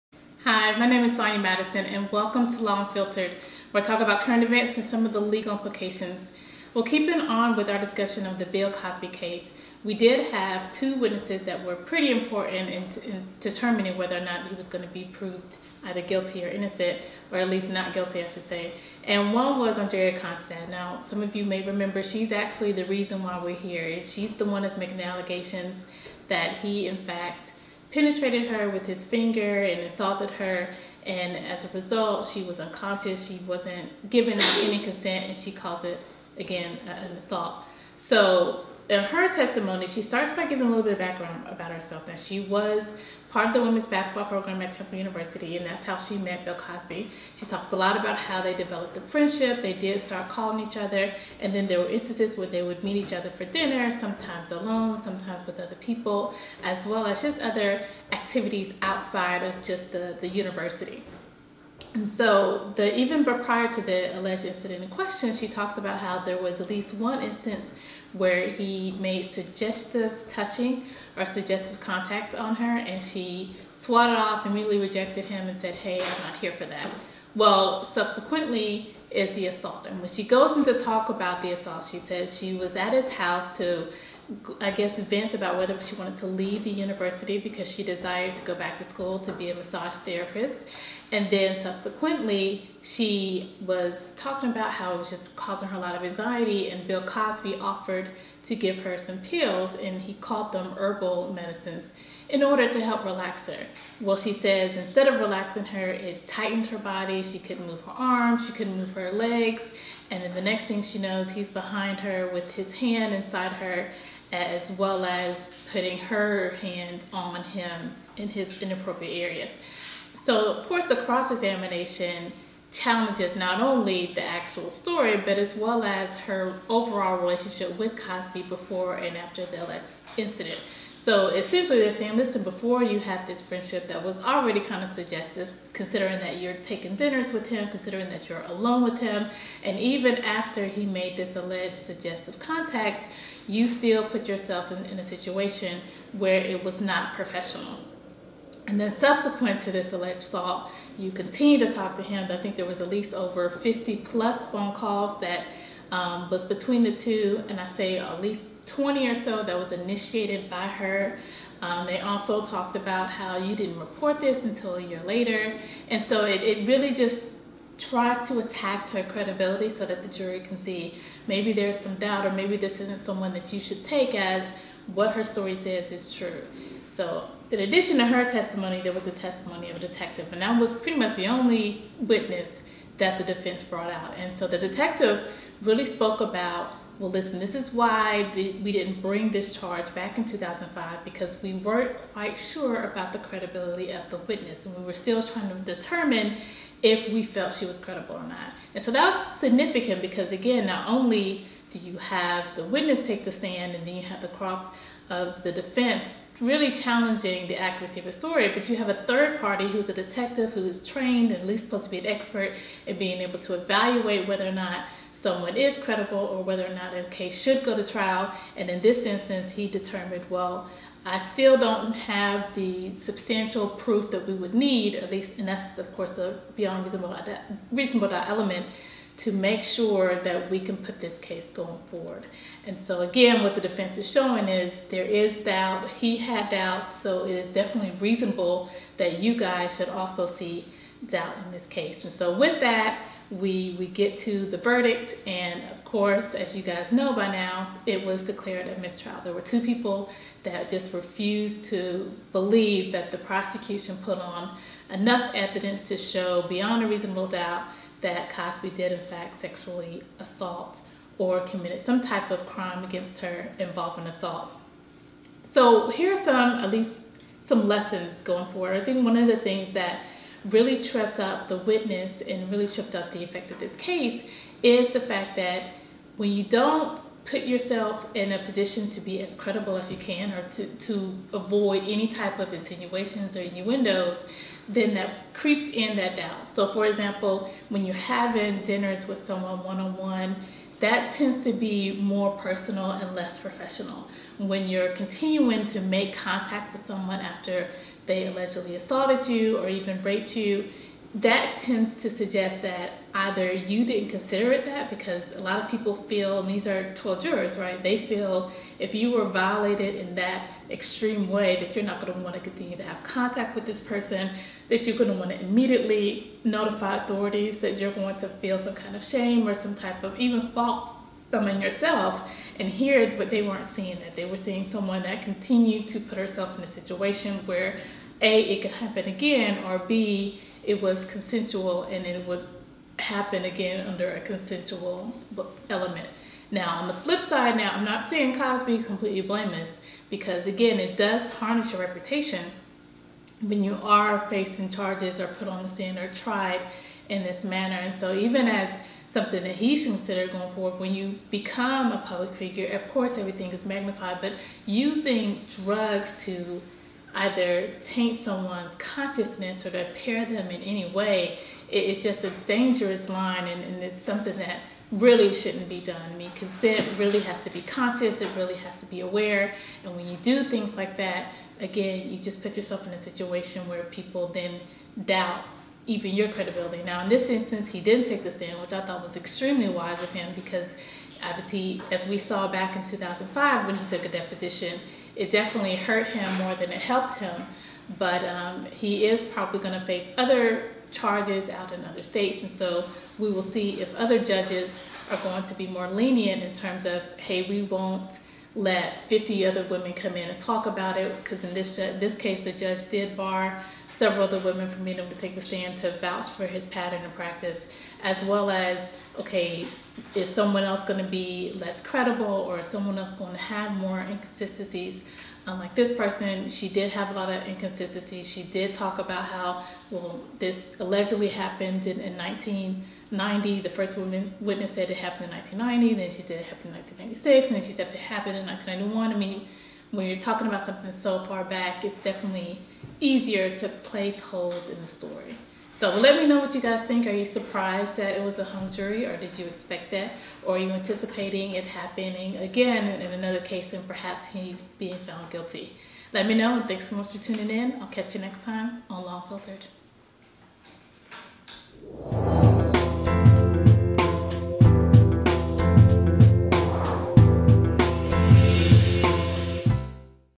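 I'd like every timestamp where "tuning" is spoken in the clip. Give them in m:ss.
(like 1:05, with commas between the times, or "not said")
7:27.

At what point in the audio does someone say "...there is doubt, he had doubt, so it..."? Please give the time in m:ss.
3:54.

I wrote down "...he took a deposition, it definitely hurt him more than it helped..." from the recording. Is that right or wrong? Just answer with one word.
right.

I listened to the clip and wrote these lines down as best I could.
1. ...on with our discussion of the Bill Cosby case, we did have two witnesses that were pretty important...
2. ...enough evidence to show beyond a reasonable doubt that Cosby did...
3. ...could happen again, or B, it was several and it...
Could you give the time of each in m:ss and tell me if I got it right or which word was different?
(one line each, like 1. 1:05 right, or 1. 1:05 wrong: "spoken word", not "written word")
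1. 0:07 right
2. 4:14 right
3. 5:28 wrong: "consensual", not "several".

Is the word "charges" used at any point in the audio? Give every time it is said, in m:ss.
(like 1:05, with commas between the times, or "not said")
3:09, 5:44, 6:30.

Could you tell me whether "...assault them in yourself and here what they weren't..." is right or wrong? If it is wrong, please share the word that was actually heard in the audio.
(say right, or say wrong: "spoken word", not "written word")
wrong: "fault", not "assault".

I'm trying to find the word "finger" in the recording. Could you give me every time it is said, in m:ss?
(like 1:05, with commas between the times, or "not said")
0:29.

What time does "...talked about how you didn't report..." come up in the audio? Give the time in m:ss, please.
2:42.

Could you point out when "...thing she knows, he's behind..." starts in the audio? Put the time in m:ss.
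1:50.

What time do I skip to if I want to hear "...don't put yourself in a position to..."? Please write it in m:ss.
4:36.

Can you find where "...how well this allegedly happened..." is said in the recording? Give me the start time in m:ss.
6:59.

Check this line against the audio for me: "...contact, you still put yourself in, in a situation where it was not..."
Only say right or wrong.
right.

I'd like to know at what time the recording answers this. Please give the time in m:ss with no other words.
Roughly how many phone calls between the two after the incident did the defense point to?
2:33.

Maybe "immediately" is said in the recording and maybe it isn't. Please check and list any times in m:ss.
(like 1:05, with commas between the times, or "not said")
1:14, 5:15.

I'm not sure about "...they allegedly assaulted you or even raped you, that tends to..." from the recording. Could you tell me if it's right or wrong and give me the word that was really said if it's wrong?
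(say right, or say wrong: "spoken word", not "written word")
right.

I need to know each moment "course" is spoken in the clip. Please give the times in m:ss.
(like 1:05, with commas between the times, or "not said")
2:00, 3:45, 4:05, 5:52.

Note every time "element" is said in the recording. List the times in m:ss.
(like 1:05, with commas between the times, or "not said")
3:48, 5:35.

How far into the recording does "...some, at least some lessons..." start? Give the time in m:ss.
4:26.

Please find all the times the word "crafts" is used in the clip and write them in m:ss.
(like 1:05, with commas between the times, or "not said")
not said.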